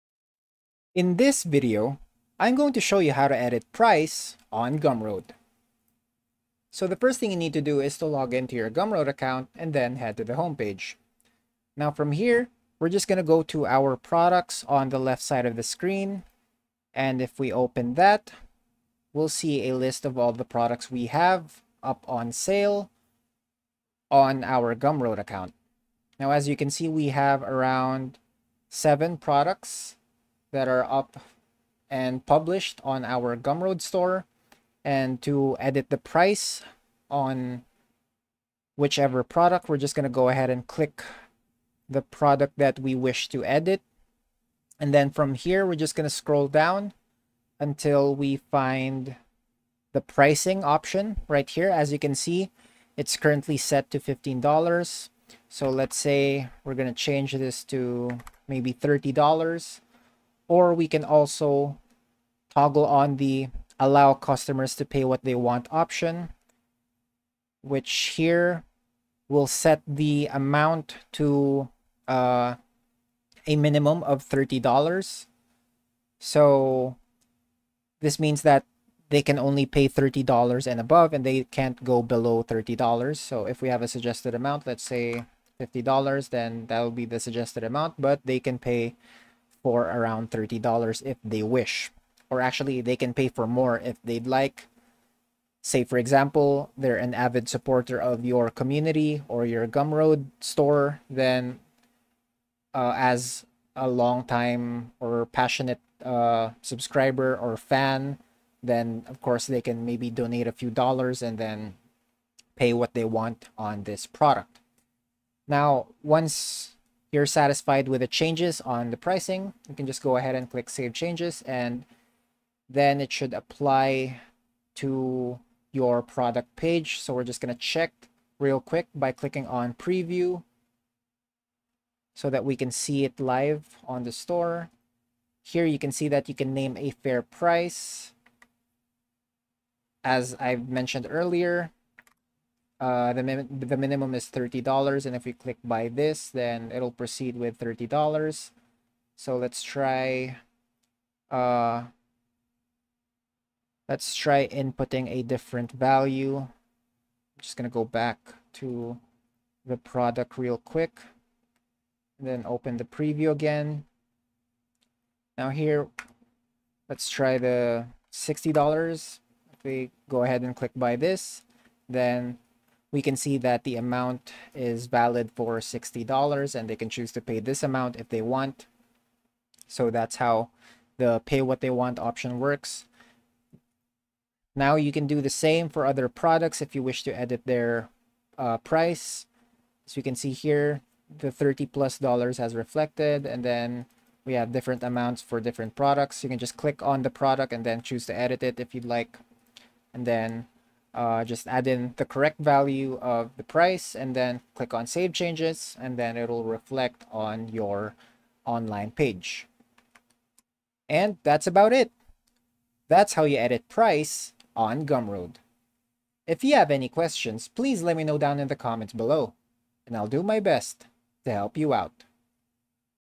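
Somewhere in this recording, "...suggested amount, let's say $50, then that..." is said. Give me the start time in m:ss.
1:23.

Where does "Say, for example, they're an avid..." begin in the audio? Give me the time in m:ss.
1:35.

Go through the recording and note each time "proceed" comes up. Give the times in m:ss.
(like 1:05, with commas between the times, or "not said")
2:26.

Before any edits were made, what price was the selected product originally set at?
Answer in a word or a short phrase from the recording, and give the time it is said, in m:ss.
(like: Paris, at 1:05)
$15, at 0:53.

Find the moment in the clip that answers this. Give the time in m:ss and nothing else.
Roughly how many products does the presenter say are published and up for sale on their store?
0:28.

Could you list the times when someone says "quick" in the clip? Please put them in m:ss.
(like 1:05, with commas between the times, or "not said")
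2:08, 2:40.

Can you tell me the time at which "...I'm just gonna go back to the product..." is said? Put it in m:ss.
2:36.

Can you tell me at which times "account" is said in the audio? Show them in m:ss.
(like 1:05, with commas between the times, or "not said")
0:09, 0:25.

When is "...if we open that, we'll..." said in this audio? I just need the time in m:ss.
0:17.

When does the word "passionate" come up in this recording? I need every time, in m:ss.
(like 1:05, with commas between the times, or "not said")
1:45.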